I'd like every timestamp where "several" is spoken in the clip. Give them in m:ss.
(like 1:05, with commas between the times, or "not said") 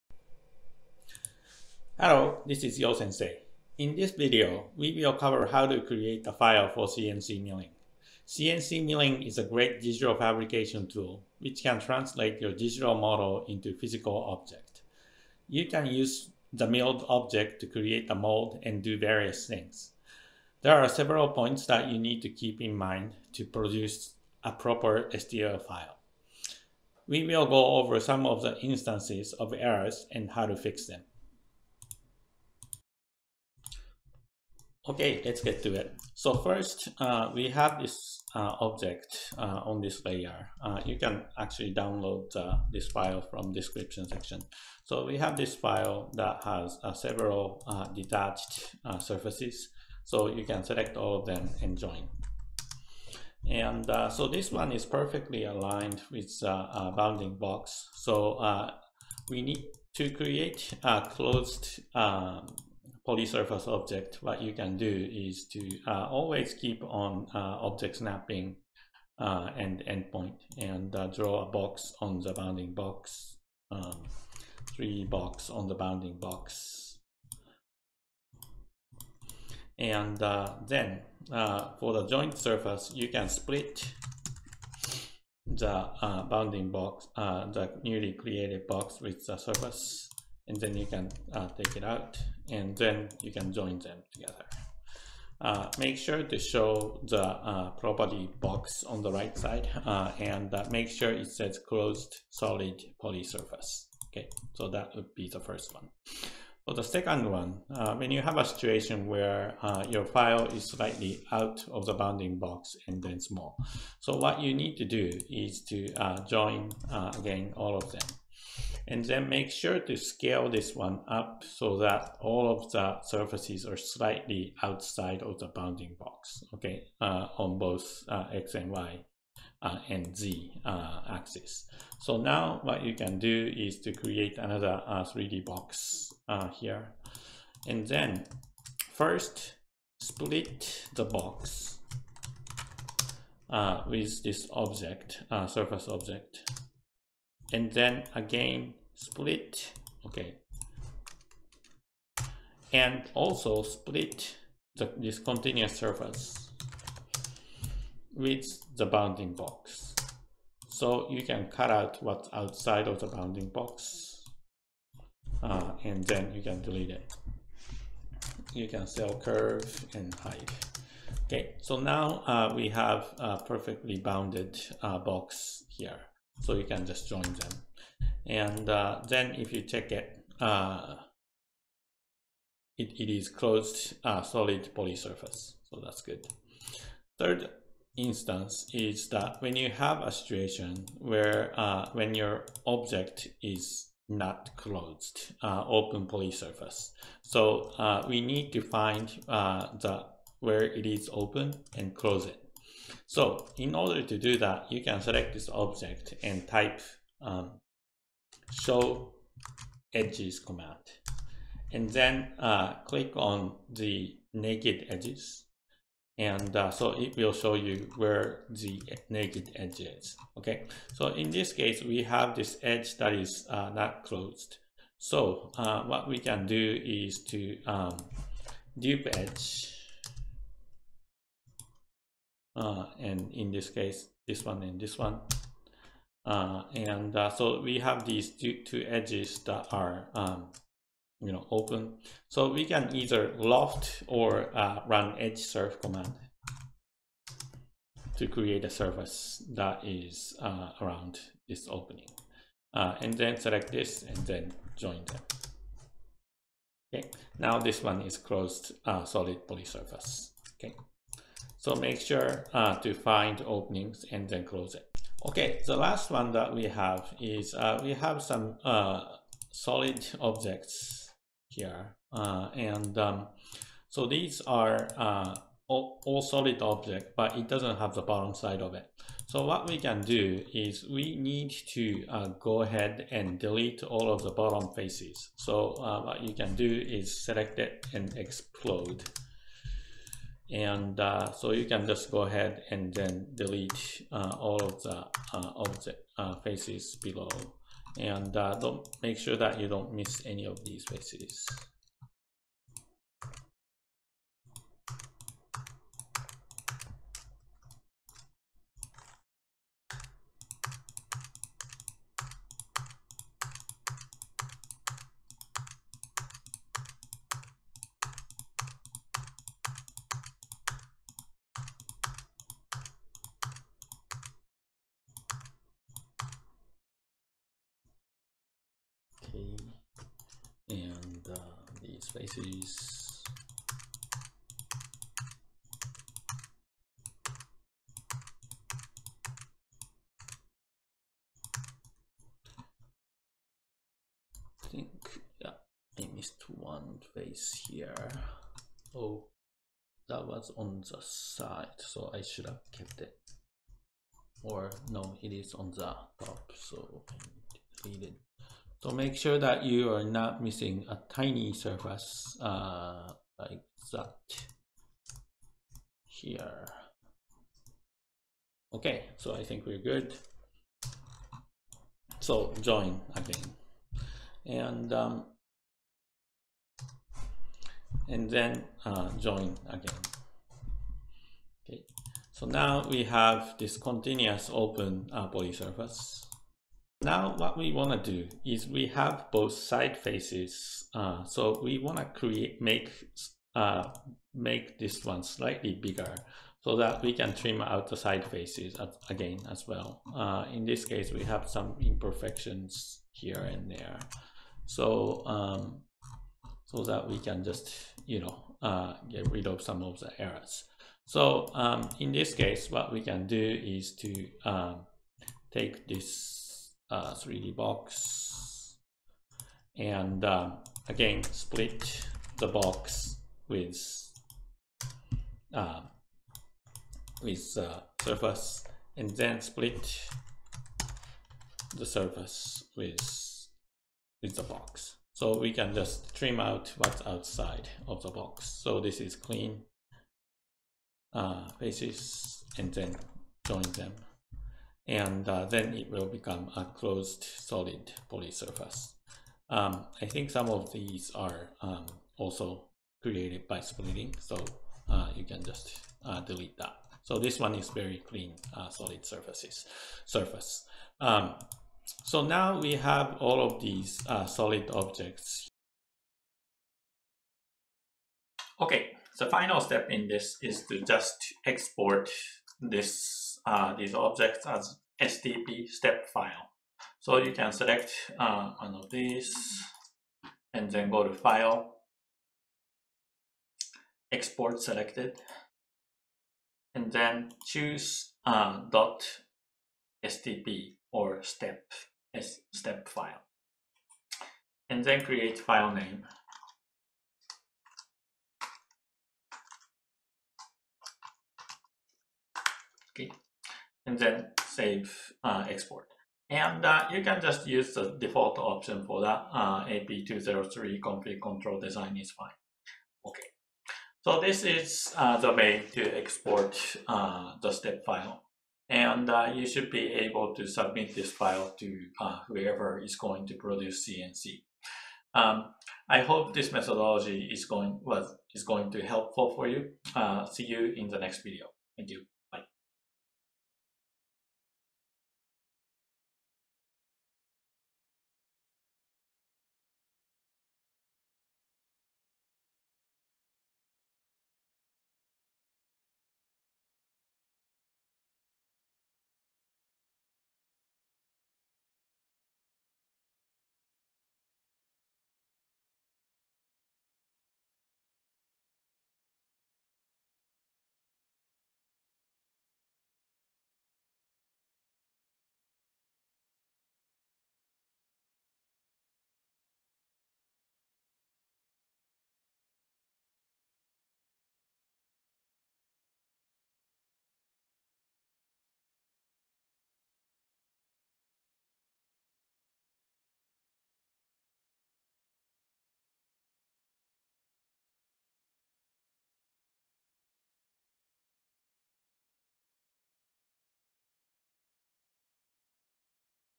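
0:20, 0:46.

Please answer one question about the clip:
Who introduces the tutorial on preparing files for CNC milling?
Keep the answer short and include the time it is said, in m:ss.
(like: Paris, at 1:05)
Yo Sensei, at 0:02.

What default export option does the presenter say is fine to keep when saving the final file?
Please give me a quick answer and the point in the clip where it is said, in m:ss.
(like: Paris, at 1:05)
AP203, at 8:29.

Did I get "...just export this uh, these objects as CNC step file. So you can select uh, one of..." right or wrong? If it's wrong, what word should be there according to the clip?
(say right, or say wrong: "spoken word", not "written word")
wrong: "STP", not "CNC".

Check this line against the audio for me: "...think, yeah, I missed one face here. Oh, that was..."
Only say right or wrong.
right.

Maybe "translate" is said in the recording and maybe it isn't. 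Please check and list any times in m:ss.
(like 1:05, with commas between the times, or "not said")
0:11.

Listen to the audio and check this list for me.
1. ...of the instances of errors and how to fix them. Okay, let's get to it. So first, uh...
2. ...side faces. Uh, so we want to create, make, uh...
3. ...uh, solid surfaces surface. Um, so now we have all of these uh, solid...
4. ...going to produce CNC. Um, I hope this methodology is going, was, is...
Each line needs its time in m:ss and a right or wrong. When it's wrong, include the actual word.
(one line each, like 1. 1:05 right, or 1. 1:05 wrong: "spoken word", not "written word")
1. 0:28 right
2. 6:29 right
3. 7:38 right
4. 8:42 right.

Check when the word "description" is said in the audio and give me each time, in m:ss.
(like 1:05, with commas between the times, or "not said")
0:43.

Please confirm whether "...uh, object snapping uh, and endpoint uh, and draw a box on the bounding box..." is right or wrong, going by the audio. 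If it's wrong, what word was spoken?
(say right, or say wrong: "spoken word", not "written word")
right.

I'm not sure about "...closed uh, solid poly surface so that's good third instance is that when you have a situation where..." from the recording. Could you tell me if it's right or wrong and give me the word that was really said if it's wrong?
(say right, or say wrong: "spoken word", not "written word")
right.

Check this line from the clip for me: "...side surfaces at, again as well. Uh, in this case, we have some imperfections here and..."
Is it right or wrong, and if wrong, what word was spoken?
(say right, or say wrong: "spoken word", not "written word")
wrong: "faces", not "surfaces".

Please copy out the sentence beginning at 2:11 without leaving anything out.
So now what you can do is to create another 3D uh, box uh, here.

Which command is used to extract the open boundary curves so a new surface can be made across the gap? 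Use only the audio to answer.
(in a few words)
dupe edge.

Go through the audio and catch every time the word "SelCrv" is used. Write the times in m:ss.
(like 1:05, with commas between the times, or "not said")
2:48.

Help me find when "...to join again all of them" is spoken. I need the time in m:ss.
1:55.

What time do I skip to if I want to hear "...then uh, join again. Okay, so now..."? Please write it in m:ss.
6:18.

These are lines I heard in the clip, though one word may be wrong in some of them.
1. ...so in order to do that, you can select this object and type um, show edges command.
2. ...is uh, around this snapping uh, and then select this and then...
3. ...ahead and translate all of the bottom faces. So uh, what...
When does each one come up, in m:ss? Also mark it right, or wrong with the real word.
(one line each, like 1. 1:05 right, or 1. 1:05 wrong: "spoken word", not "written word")
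1. 3:23 right
2. 4:09 wrong: "opening", not "snapping"
3. 4:42 wrong: "delete", not "translate".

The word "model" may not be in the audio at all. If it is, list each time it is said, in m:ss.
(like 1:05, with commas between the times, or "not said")
0:12.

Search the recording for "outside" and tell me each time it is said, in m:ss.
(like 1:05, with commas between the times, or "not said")
2:04, 2:42, 7:17.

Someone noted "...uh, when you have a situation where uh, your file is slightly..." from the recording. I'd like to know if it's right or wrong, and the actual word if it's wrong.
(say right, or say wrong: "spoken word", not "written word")
right.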